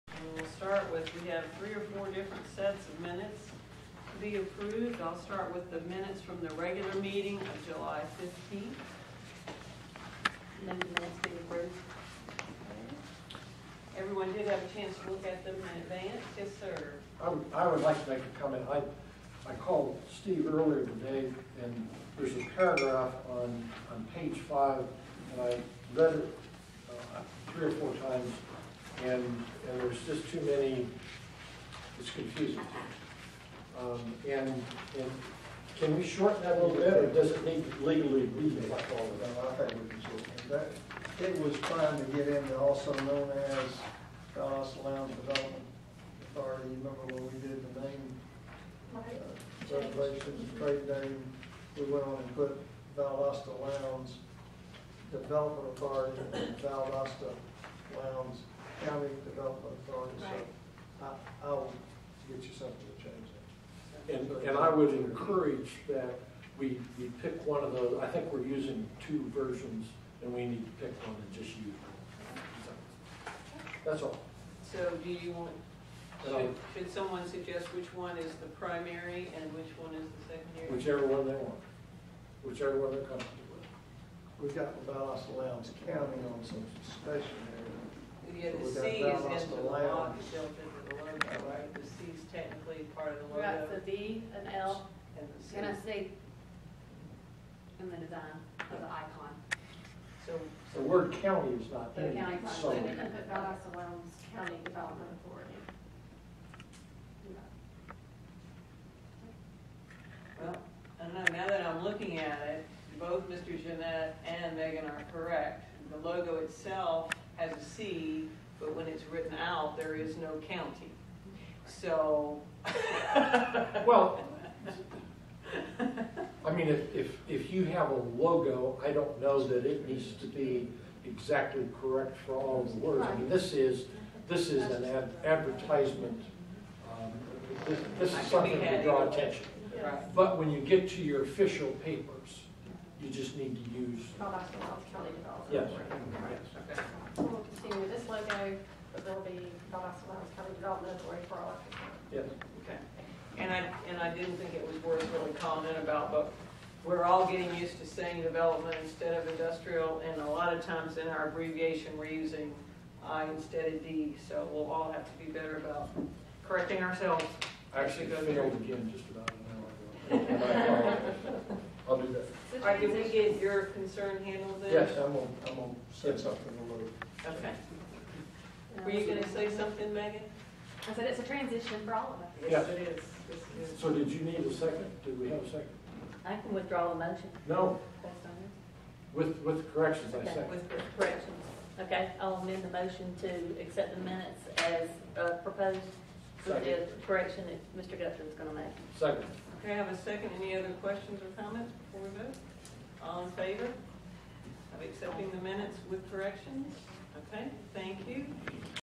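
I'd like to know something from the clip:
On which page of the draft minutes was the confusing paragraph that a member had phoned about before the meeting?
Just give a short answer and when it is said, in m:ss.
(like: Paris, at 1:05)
page 5, at 0:24.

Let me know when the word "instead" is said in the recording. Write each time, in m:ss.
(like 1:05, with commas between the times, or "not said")
2:38, 2:43.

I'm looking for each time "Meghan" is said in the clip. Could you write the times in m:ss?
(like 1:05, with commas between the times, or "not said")
1:54, 2:59.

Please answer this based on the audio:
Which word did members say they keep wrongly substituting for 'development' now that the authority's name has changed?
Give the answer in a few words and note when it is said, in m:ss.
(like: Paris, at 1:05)
industrial, at 2:39.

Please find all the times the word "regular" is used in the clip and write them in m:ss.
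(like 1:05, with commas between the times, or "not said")
0:06.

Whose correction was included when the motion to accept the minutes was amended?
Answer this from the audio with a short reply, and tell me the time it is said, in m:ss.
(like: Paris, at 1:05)
Mr. Gupton, at 3:17.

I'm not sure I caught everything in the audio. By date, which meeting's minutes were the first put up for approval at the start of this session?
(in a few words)
July 15th.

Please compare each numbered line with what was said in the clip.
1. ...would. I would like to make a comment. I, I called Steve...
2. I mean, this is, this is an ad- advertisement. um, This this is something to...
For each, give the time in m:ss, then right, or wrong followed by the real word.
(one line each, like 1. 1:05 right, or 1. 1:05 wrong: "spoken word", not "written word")
1. 0:17 right
2. 2:13 right.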